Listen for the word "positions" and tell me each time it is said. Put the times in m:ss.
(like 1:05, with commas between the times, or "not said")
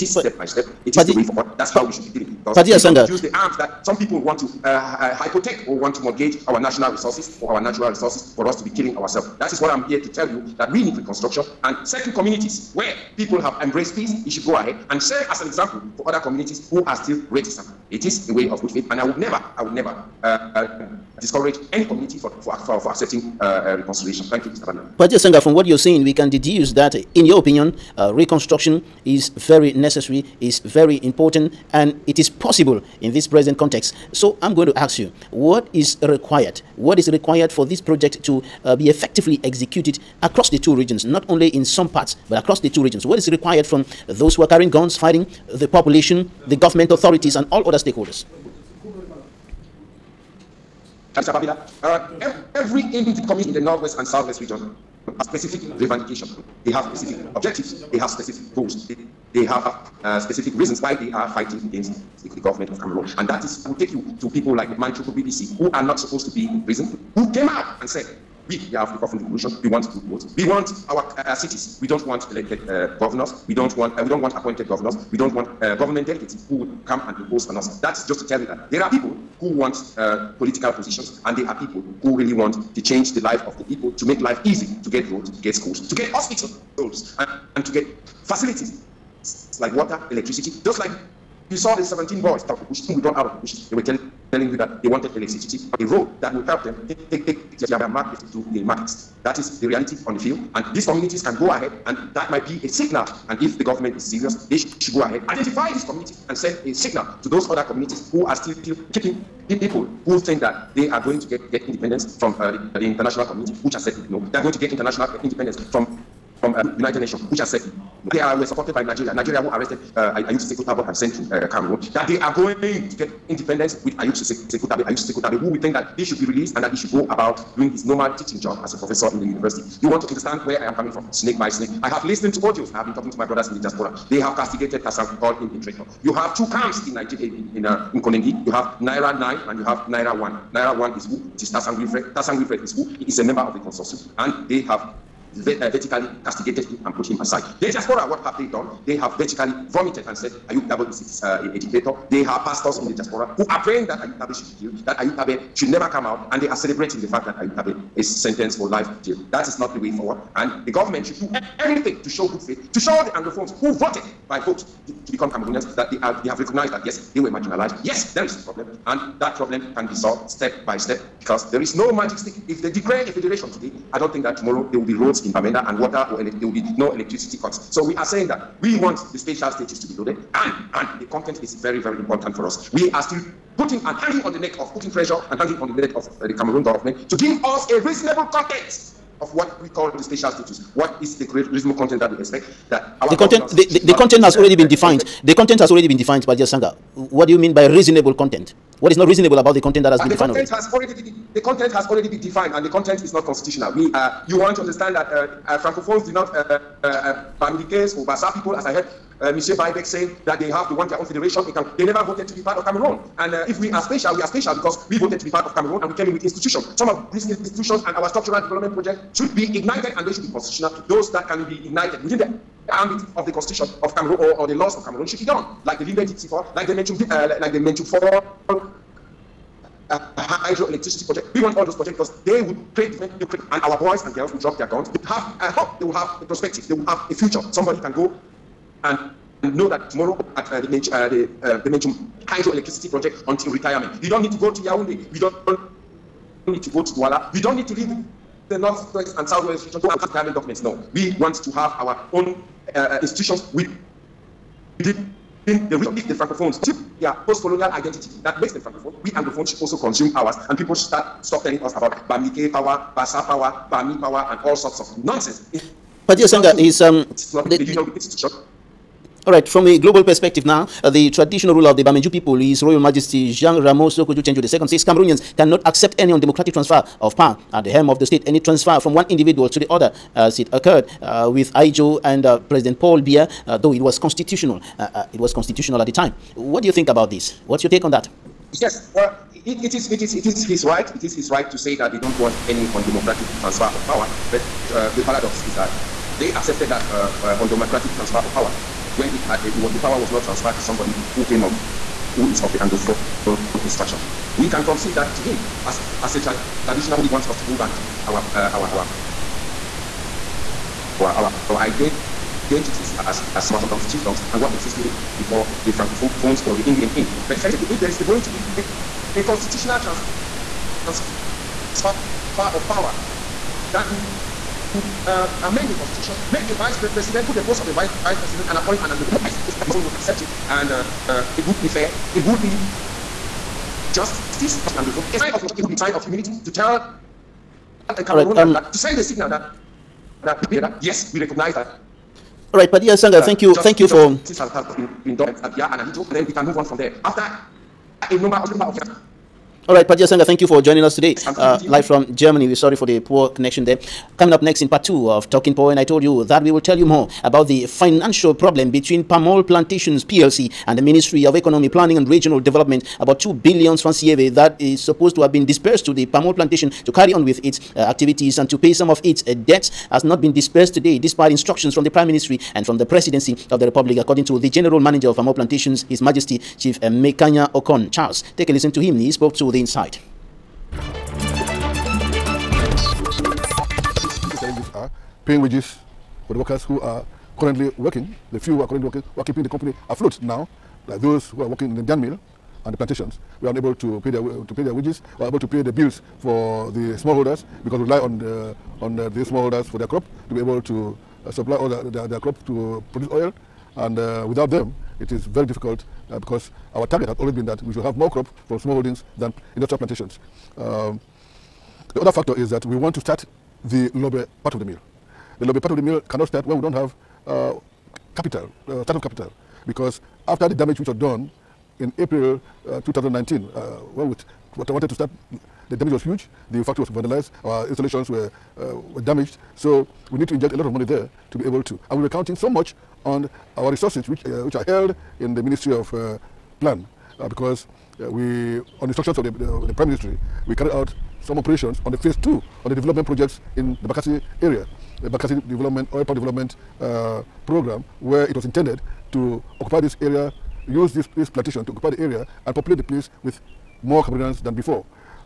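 1:20.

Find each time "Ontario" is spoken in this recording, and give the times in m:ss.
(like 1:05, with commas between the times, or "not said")
not said.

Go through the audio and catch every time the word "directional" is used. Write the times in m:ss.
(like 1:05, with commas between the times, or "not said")
not said.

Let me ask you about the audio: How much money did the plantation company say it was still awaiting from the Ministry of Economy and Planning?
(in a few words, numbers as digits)
2 billion francs.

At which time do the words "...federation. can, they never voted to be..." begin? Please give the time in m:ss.
3:31.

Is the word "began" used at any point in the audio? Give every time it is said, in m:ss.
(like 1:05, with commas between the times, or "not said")
not said.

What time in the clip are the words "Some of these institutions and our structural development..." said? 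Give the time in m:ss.
3:36.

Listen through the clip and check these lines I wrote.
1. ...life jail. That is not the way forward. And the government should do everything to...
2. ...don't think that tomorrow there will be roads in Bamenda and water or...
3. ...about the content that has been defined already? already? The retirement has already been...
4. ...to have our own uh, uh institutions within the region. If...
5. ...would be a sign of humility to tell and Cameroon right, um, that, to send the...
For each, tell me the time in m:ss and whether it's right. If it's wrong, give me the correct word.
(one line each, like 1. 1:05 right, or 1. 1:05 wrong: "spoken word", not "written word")
1. 2:38 right
2. 2:53 right
3. 3:19 wrong: "content", not "retirement"
4. 4:11 right
5. 5:35 right.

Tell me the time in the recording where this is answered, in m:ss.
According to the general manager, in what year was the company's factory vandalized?
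7:02.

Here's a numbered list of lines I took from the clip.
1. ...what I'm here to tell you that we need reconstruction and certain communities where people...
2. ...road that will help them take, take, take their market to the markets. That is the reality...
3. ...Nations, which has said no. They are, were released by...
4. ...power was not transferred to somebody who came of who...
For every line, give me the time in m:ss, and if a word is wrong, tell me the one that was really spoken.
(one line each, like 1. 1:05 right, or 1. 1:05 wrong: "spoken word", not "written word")
1. 0:09 right
2. 1:35 right
3. 1:56 wrong: "supported", not "released"
4. 4:59 right.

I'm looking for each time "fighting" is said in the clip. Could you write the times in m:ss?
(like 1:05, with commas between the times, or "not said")
0:44, 1:01.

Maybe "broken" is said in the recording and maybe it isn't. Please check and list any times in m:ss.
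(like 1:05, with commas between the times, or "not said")
not said.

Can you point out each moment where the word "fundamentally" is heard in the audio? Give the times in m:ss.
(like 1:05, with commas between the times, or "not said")
not said.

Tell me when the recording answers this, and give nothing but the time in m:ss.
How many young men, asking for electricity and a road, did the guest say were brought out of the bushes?
1:31.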